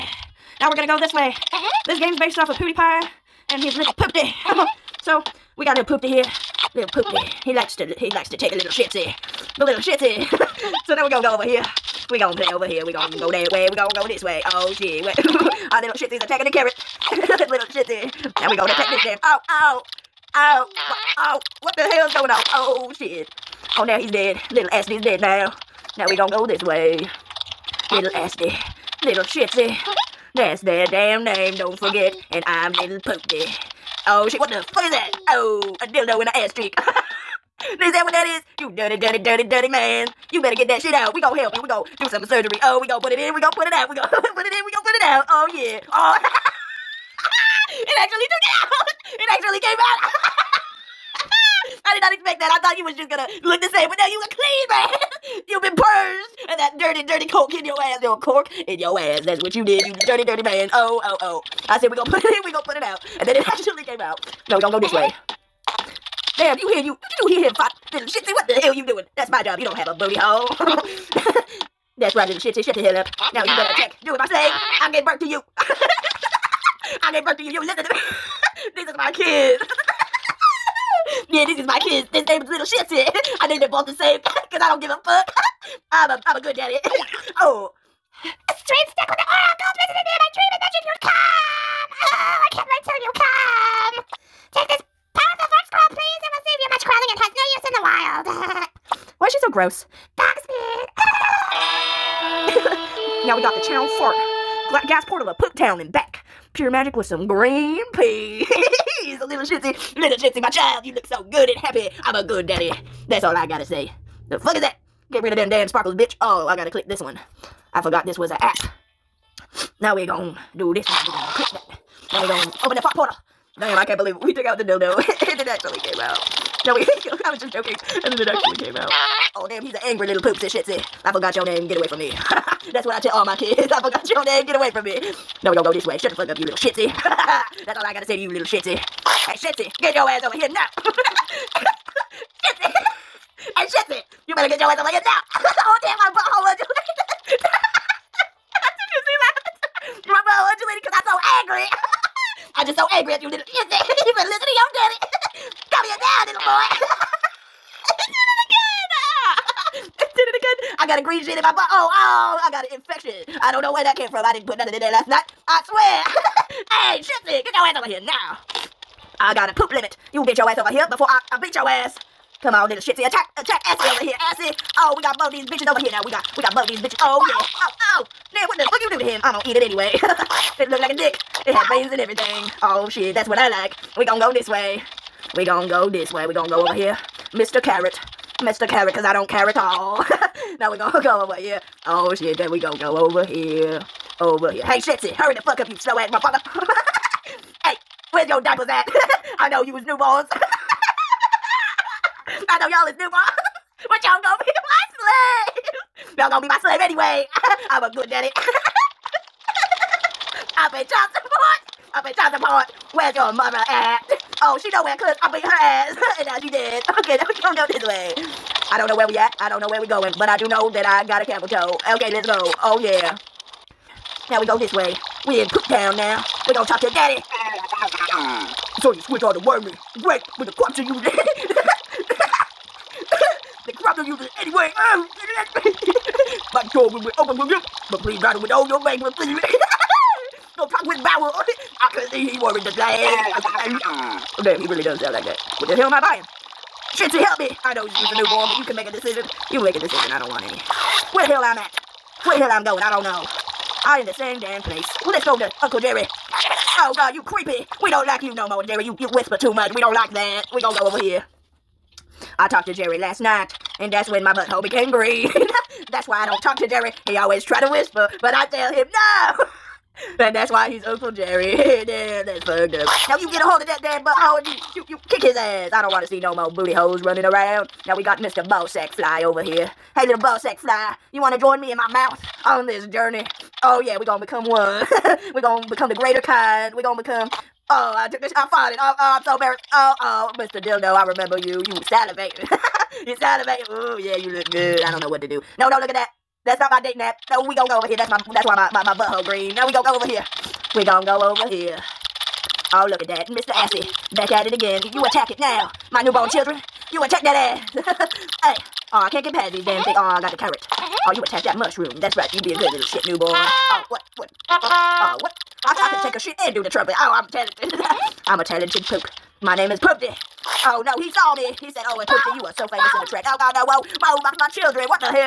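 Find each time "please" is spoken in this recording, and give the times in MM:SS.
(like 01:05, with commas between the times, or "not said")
03:57.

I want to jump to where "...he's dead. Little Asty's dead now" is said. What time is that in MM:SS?
00:23.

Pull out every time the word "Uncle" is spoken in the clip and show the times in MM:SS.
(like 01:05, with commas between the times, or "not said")
04:15, 04:30.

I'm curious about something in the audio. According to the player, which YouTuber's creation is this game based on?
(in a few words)
PewDiePie.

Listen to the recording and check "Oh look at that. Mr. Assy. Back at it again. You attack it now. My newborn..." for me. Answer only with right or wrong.
right.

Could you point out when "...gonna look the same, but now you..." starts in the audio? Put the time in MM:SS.
00:53.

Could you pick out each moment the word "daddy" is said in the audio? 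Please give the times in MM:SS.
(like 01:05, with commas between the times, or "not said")
01:26, 01:52, 03:28, 03:46.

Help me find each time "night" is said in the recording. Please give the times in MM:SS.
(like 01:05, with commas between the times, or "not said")
02:45, 04:23.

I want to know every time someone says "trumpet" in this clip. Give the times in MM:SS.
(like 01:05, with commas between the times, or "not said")
05:16.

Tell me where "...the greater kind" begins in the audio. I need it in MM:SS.
04:45.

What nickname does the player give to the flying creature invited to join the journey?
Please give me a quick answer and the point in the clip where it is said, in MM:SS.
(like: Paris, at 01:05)
Mr. Ballsack Fly, at 04:38.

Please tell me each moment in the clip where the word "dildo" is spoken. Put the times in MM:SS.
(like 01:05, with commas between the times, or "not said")
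00:35, 02:04, 04:50.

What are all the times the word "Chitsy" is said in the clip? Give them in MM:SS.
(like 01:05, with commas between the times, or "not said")
04:06.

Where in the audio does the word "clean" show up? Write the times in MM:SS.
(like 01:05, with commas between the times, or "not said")
00:54.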